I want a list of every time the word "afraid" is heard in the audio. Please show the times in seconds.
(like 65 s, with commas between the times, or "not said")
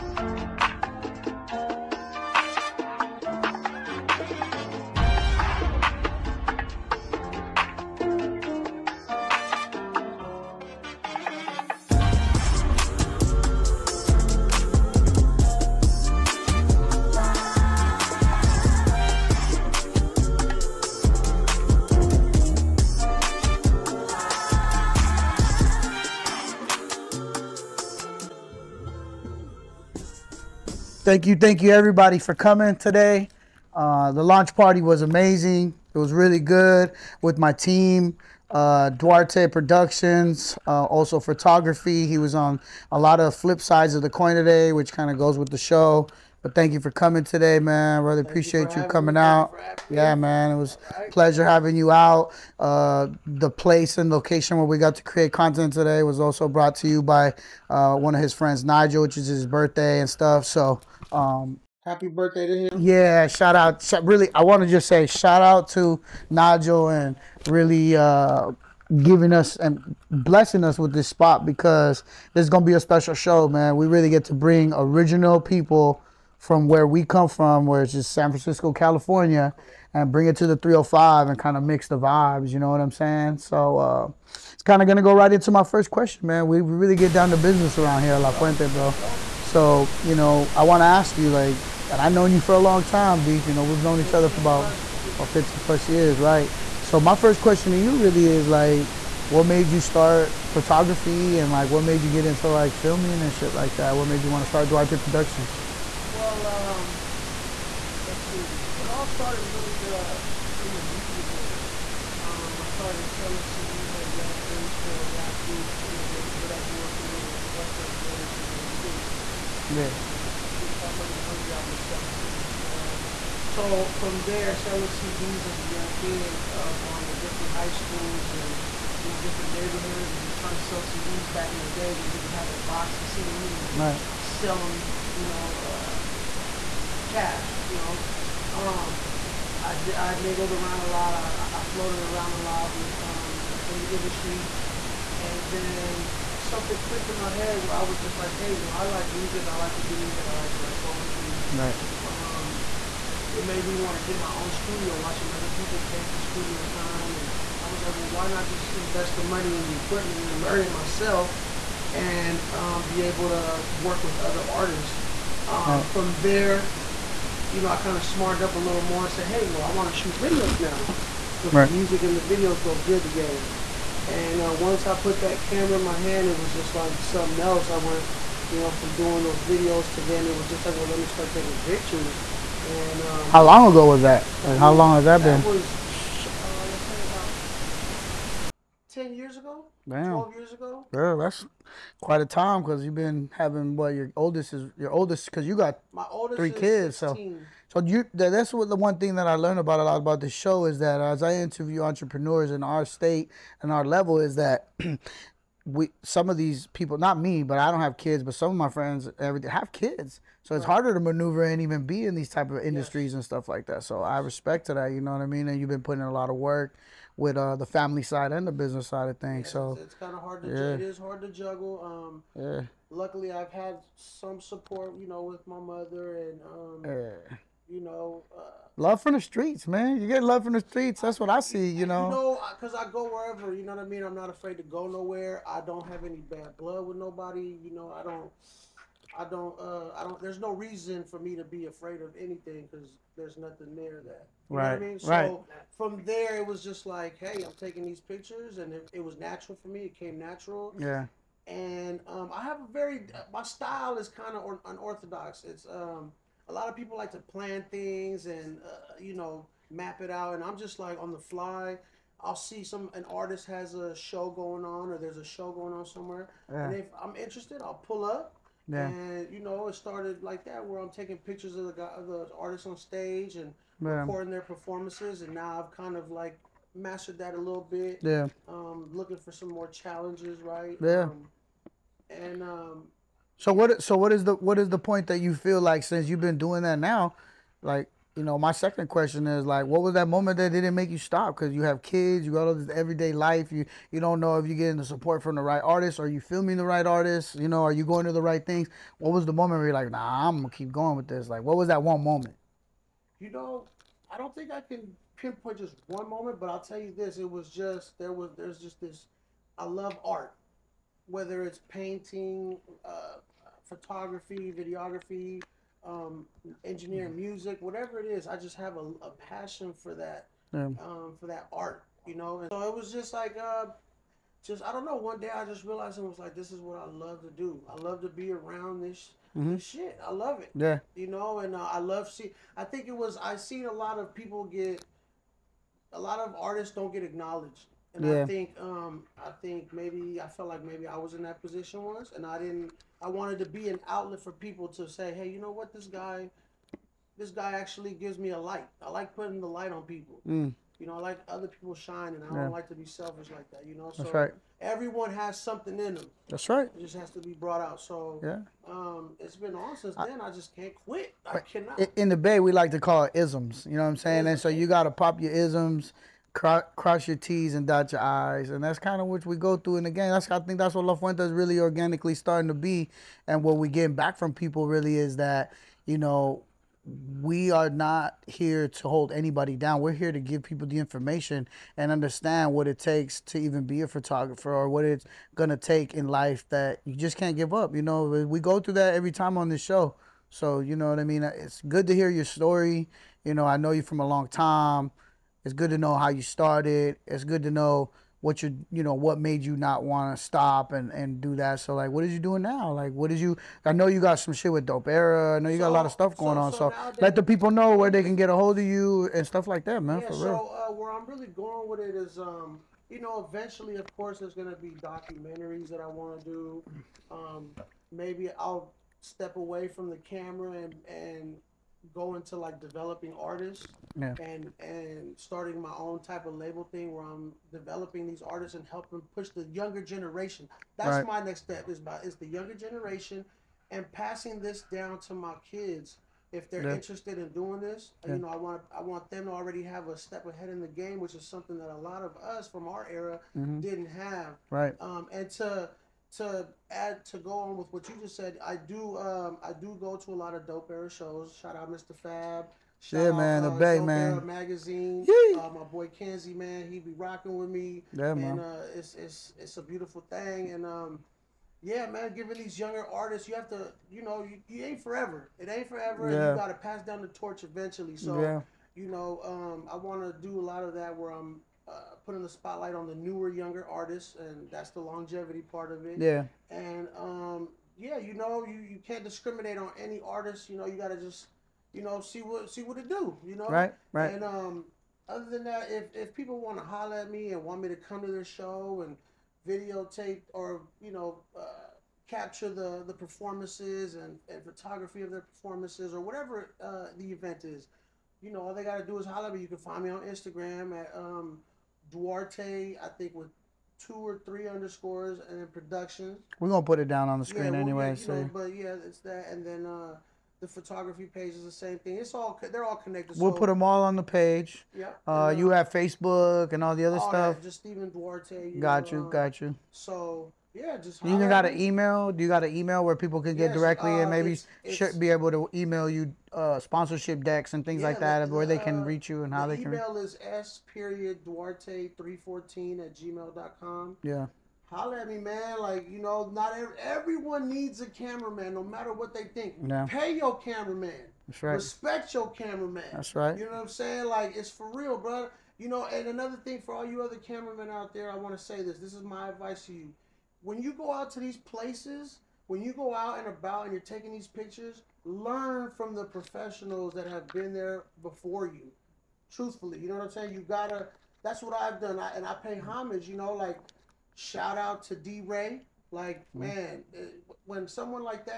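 234 s, 241 s.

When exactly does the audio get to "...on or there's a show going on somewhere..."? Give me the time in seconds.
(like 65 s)
264 s.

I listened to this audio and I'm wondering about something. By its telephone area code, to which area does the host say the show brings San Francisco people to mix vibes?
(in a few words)
305.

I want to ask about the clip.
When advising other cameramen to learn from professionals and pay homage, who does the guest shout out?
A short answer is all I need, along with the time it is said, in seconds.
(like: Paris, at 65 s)
D Ray, at 564 s.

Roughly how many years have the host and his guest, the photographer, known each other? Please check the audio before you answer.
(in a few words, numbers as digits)
15 plus years.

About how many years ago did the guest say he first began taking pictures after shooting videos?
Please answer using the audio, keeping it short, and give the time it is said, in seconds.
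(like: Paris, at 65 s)
10, at 188 s.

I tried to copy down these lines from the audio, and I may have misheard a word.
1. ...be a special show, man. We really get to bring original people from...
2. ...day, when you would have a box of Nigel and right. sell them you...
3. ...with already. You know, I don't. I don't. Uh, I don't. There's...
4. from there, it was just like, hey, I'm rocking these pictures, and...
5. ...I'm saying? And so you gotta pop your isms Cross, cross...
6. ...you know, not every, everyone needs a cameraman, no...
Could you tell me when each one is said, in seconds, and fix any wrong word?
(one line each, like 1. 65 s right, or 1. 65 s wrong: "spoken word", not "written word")
1. 72 s right
2. 131 s wrong: "CDs", not "Nigel"
3. 236 s wrong: "nobody", not "already"
4. 245 s wrong: "taking", not "rocking"
5. 363 s right
6. 535 s right.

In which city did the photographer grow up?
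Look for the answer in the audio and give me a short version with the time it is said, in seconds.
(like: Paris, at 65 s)
Daly City, at 118 s.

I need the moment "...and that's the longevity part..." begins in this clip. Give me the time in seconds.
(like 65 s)
474 s.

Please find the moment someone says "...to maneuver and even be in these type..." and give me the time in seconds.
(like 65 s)
210 s.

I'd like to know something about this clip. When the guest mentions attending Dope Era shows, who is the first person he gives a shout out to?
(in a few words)
Mr. Fab.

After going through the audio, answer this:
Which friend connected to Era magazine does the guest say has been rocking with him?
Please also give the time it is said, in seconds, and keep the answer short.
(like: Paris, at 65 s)
Kenzie, at 455 s.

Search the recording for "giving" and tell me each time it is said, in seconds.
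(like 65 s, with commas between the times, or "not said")
69 s, 462 s.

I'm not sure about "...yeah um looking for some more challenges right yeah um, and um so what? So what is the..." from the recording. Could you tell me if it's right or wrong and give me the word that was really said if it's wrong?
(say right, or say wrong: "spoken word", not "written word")
right.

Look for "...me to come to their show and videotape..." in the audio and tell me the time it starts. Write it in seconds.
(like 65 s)
487 s.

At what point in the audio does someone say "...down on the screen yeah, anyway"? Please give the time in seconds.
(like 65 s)
506 s.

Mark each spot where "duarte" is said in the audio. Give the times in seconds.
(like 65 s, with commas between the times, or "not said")
38 s, 104 s, 501 s, 517 s, 531 s.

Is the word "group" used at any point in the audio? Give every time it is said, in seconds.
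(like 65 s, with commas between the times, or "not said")
115 s, 120 s.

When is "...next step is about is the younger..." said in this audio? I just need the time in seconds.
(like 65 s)
431 s.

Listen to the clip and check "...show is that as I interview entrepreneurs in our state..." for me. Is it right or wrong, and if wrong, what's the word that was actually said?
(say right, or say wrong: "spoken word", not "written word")
right.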